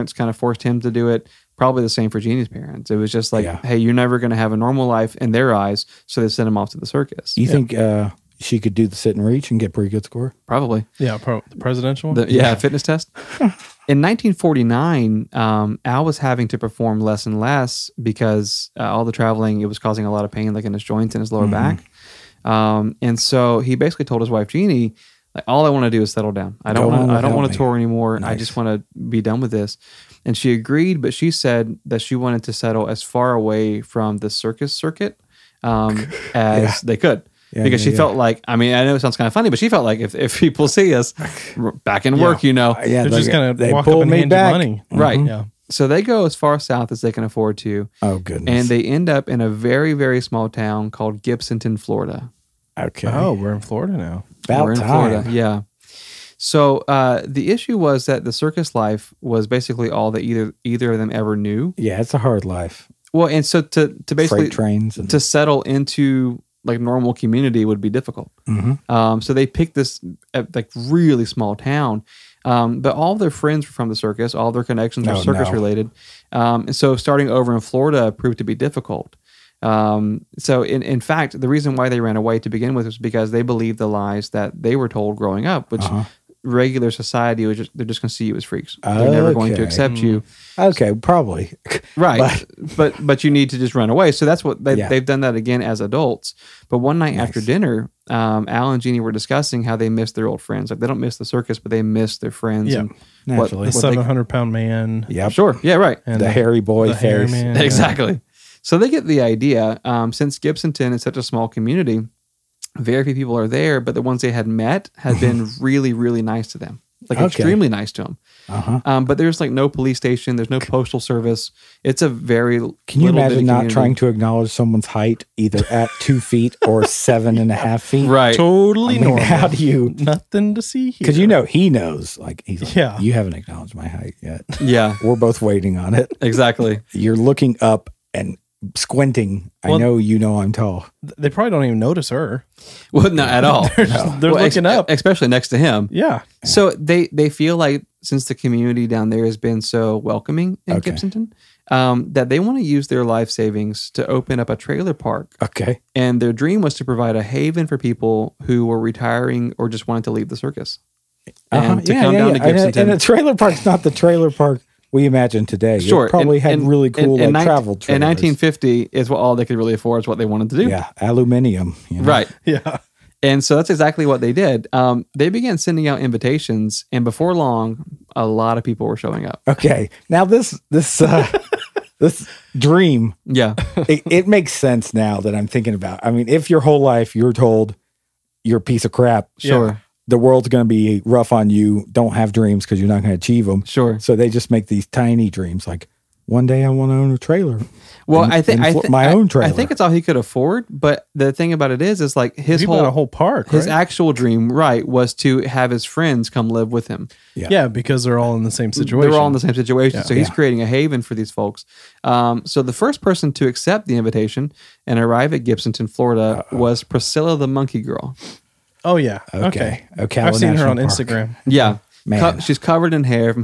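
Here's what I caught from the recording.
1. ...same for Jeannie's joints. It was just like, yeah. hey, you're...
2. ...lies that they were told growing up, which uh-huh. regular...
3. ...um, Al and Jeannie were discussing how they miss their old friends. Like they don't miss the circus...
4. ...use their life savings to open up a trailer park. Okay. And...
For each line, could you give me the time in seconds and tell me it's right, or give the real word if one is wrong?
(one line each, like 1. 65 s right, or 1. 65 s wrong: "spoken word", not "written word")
1. 1 s wrong: "parents", not "joints"
2. 83 s right
3. 98 s right
4. 152 s right.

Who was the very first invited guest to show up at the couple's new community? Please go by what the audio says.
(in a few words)
Priscilla the Monkey Girl.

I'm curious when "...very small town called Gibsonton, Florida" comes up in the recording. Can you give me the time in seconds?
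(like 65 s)
49 s.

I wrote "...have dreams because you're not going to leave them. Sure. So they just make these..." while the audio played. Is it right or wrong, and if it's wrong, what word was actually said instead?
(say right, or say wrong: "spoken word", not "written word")
wrong: "achieve", not "leave".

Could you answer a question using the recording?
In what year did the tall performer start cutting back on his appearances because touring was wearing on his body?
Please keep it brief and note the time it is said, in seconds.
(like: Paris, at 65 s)
1949, at 14 s.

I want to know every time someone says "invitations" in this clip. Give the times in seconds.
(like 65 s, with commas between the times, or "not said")
176 s, 213 s.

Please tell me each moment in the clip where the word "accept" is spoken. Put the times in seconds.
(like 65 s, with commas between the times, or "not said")
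89 s, 213 s.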